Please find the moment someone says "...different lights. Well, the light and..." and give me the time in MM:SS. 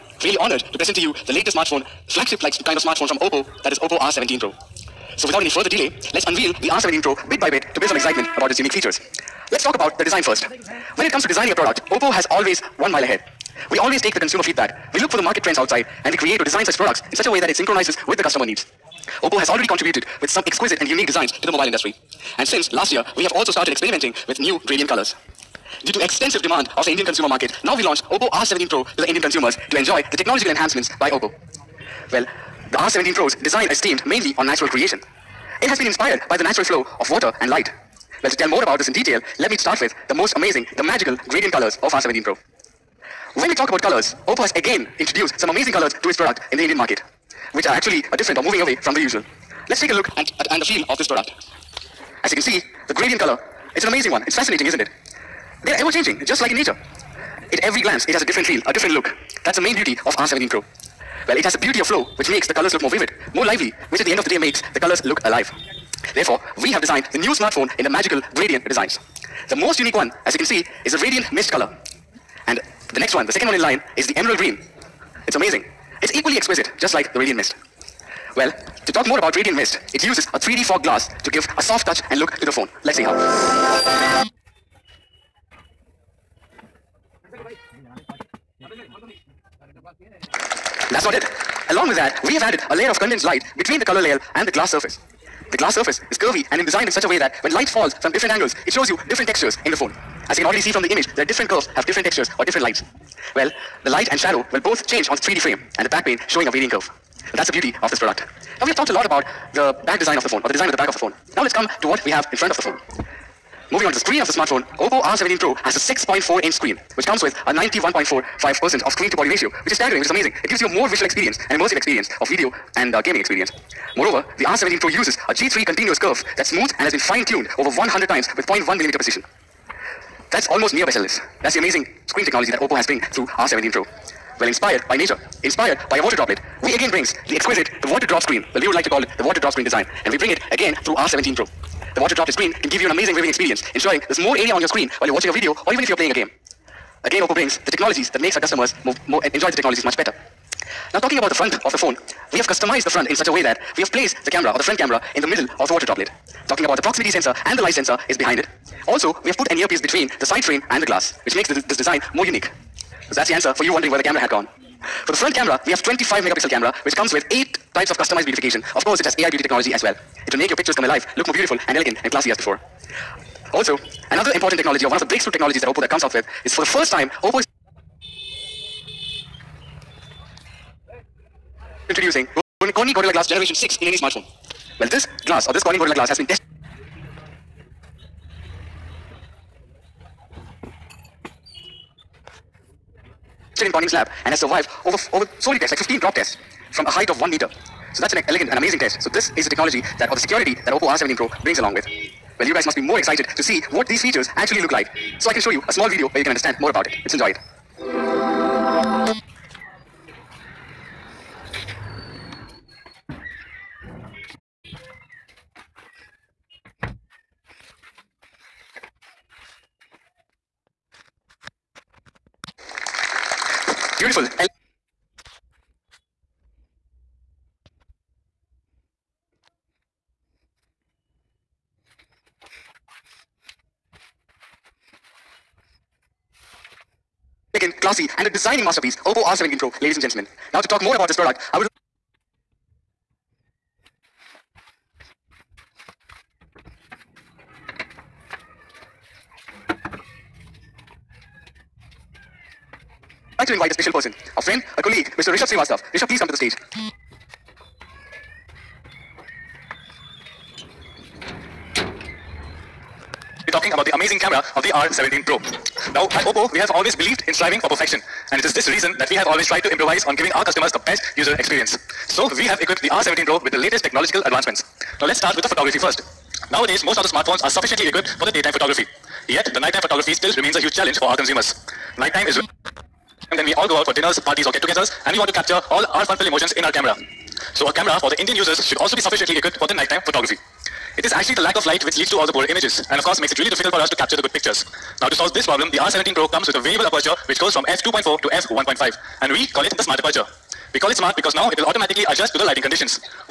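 01:42.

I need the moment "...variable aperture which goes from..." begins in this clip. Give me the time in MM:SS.
04:56.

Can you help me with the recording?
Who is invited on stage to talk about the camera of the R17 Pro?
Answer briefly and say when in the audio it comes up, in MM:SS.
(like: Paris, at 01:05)
Rishabh Srivastav, at 04:15.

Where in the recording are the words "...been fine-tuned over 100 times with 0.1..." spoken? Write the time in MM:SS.
02:06.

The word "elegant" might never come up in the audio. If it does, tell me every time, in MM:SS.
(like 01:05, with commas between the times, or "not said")
02:51, 03:18.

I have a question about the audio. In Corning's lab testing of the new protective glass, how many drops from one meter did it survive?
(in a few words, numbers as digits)
15.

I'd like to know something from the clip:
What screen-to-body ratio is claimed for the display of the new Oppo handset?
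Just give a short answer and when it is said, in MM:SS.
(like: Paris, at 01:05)
91.45%, at 01:57.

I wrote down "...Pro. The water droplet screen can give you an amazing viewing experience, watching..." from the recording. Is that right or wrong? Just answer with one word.
wrong.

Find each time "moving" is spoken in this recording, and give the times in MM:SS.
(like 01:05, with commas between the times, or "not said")
00:48, 01:53.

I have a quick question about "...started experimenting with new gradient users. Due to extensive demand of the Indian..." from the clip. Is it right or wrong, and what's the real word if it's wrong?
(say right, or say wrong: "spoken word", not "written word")
wrong: "colors", not "users".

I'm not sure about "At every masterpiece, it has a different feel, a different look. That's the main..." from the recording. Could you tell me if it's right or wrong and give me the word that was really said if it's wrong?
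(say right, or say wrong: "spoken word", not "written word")
wrong: "glance", not "masterpiece".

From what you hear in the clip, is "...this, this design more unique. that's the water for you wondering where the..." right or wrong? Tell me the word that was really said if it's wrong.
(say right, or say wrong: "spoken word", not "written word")
wrong: "answer", not "water".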